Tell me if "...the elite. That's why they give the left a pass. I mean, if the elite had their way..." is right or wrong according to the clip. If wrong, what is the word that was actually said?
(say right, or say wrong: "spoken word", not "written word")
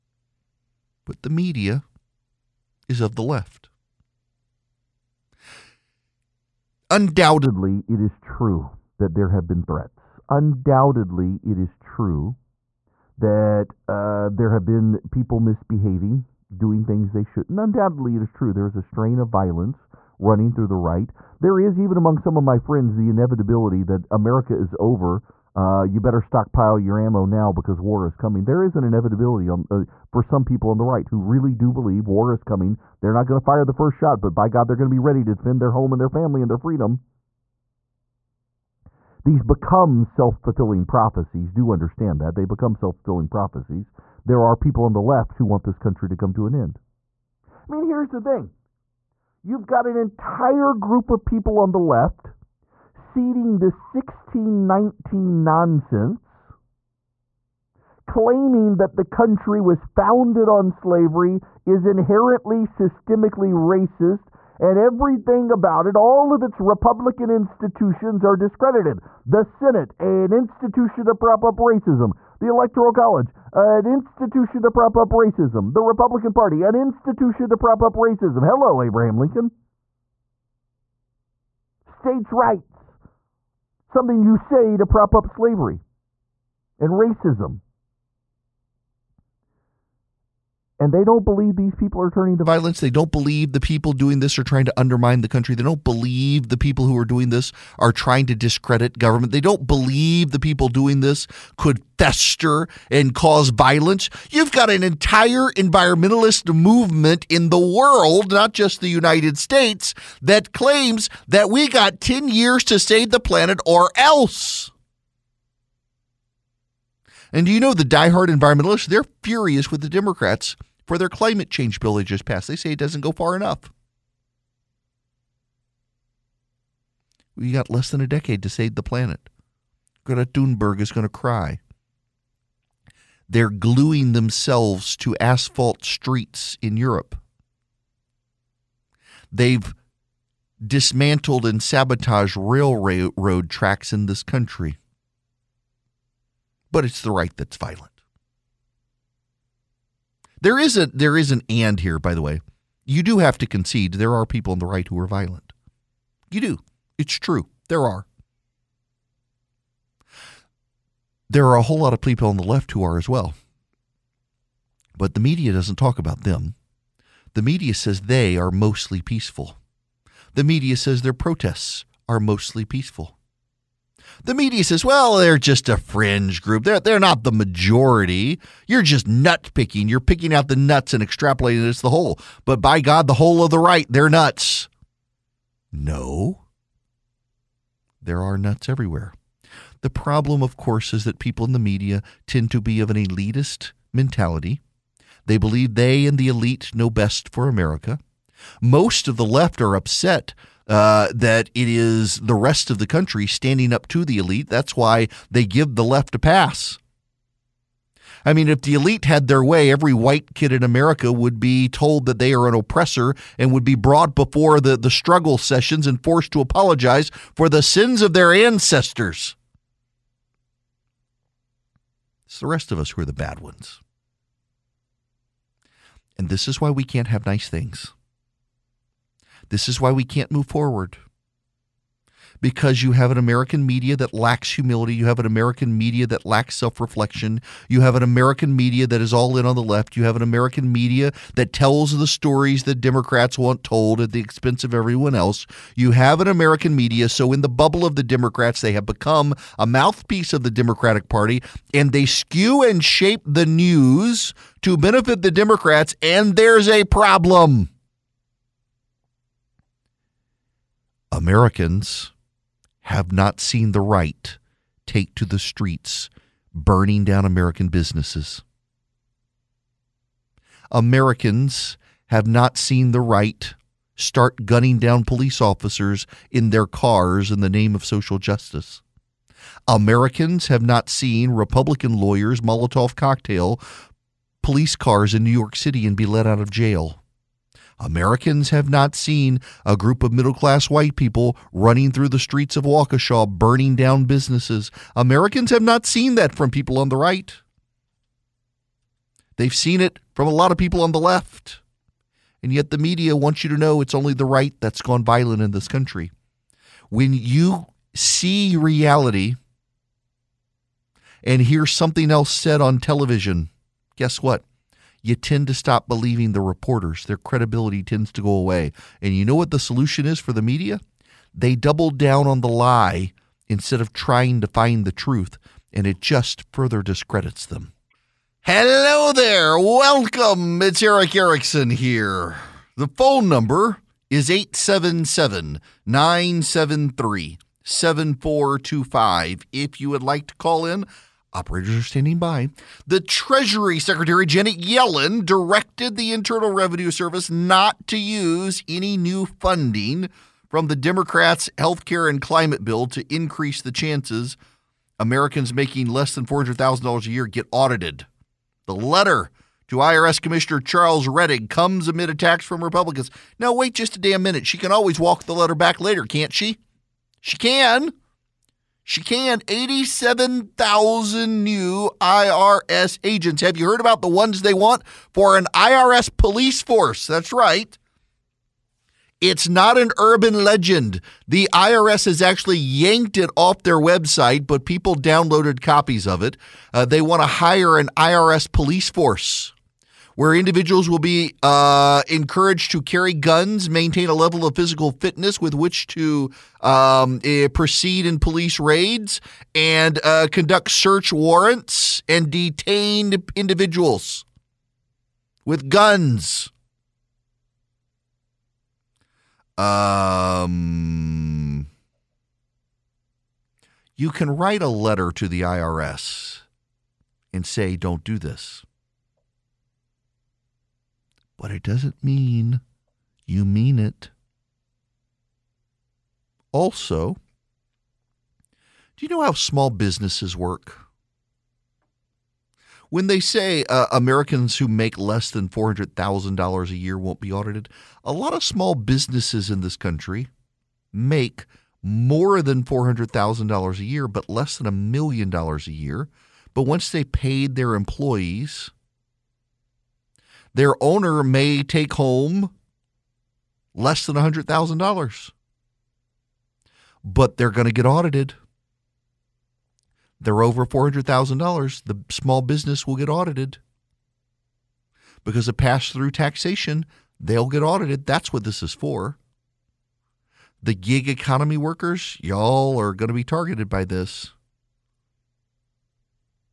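right.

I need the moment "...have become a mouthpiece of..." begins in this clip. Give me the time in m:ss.
4:08.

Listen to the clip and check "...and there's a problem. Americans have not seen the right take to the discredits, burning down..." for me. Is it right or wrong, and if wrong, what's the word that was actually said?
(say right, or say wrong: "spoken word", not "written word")
wrong: "streets", not "discredits".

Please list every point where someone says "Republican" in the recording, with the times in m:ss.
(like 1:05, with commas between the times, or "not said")
1:06, 1:15, 4:41, 6:02.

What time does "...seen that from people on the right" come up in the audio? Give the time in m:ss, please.
4:55.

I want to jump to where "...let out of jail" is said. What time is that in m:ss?
4:46.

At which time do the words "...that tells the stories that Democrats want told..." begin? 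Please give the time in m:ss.
4:01.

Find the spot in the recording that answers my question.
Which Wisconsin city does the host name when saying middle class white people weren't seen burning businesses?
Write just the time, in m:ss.
4:52.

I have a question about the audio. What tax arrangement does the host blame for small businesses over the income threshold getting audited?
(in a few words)
pass through taxation.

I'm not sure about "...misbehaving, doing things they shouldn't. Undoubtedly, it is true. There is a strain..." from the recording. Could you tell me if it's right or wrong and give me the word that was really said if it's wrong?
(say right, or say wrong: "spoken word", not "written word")
right.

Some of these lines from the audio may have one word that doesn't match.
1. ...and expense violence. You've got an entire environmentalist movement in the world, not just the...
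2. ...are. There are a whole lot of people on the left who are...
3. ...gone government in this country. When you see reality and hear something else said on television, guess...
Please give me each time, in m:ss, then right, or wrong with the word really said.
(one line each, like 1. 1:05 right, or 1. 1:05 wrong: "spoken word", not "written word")
1. 1:42 wrong: "cause", not "expense"
2. 2:37 right
3. 5:04 wrong: "violent", not "government".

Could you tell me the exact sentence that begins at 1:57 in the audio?
And do you know the diehard environmentalists?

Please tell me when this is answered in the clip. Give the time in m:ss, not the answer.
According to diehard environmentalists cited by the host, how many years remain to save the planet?
1:52.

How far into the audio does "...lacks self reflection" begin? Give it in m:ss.
3:56.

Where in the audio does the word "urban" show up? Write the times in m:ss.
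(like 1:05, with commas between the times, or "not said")
6:19.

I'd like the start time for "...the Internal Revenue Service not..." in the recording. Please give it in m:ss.
5:45.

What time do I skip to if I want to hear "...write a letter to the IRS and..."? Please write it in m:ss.
6:54.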